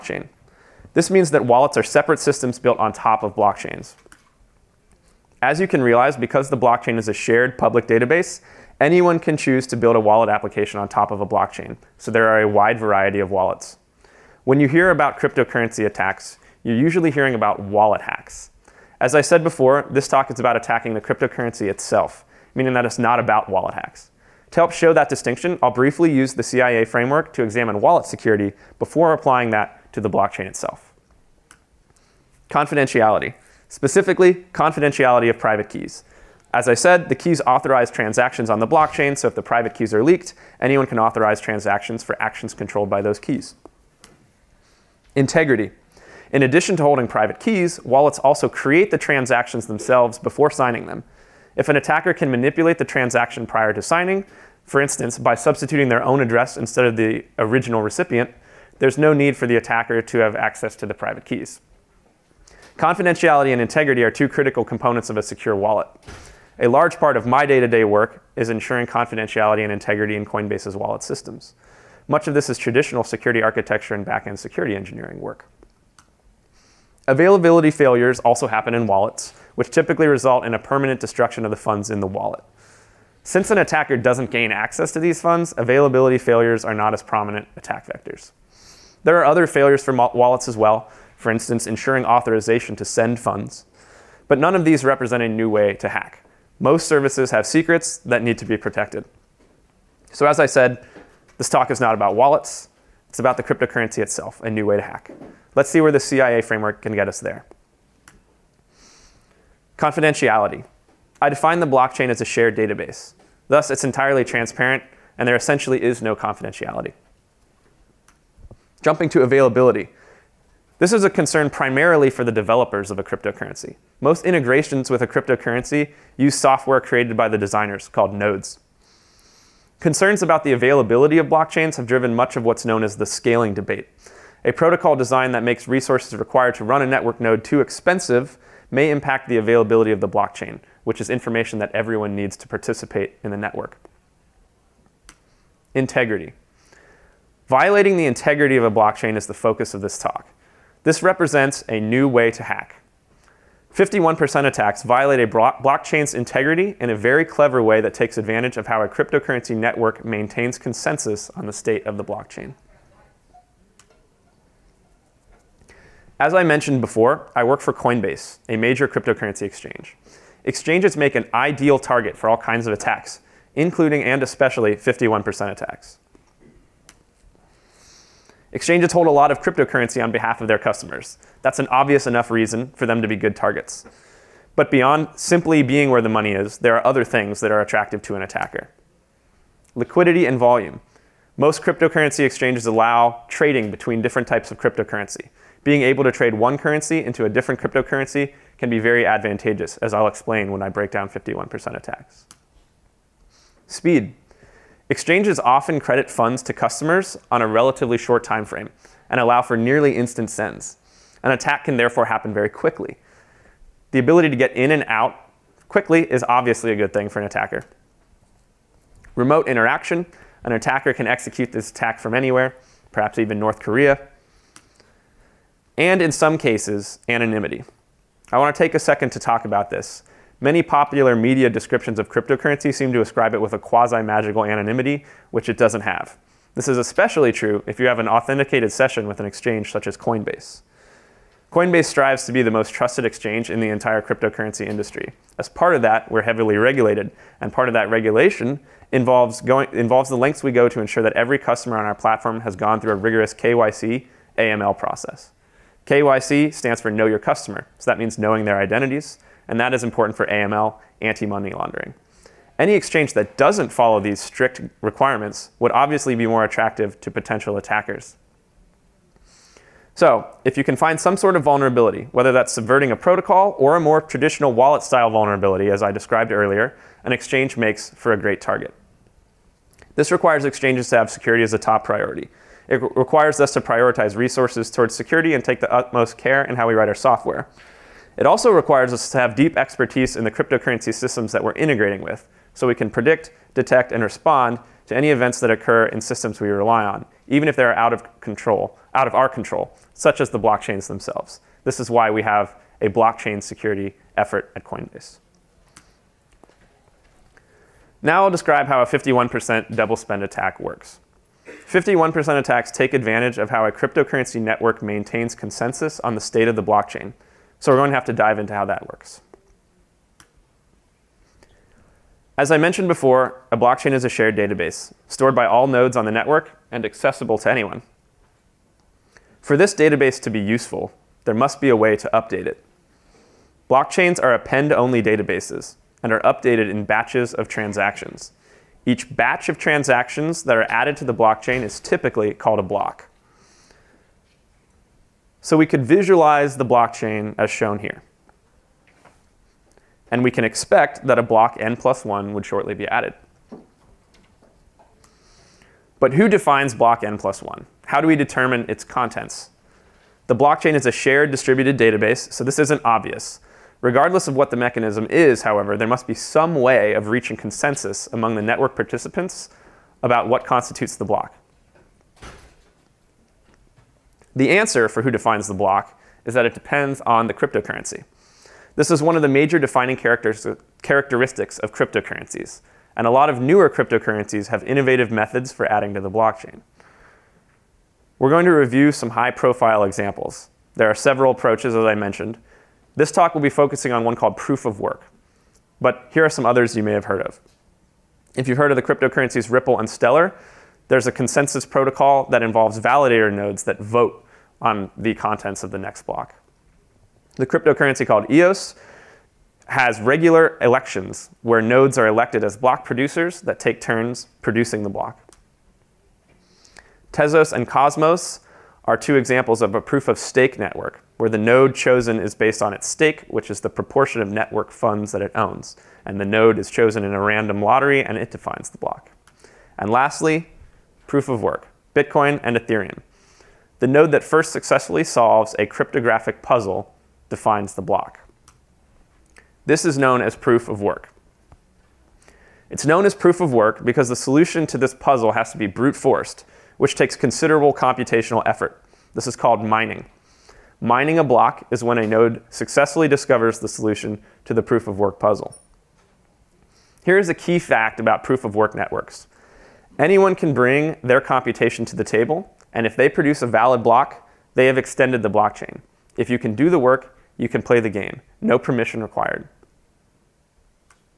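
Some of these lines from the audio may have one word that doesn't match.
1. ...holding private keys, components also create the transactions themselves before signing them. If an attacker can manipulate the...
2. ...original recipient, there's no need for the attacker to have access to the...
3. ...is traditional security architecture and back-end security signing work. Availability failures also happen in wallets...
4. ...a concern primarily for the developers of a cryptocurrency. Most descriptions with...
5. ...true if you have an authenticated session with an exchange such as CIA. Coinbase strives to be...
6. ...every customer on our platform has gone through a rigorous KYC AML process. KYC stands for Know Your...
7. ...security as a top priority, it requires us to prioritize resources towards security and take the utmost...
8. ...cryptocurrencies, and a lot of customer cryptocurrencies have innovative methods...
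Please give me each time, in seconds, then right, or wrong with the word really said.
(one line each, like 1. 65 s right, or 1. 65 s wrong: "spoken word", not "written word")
1. 46 s wrong: "wallets", not "components"
2. 57 s right
3. 72 s wrong: "engineering", not "signing"
4. 121 s wrong: "integrations", not "descriptions"
5. 237 s wrong: "Coinbase", not "CIA"
6. 251 s right
7. 281 s right
8. 381 s wrong: "newer", not "customer".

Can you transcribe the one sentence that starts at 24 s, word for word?
To help show that distinction, I'll briefly use the CIA framework to examine wallet security before applying that to the blockchain itself.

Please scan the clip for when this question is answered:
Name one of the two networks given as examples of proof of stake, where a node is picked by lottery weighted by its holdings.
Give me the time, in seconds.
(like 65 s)
417 s.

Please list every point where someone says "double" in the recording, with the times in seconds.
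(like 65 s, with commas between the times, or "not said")
309 s.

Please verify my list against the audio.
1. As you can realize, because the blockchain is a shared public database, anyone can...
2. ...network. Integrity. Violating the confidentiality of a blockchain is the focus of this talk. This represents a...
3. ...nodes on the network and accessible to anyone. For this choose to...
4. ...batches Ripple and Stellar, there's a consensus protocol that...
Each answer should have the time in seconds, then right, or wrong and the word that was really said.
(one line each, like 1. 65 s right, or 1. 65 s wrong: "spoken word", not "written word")
1. 5 s right
2. 143 s wrong: "integrity", not "confidentiality"
3. 325 s wrong: "database", not "choose"
4. 398 s wrong: "cryptocurrencies", not "batches".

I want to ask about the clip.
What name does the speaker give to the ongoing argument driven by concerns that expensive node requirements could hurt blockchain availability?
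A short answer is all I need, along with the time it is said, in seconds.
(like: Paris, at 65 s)
the scaling debate, at 133 s.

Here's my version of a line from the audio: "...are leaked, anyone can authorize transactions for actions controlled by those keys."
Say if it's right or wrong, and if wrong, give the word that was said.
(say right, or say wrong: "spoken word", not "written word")
right.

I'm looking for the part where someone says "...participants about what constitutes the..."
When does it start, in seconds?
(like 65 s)
368 s.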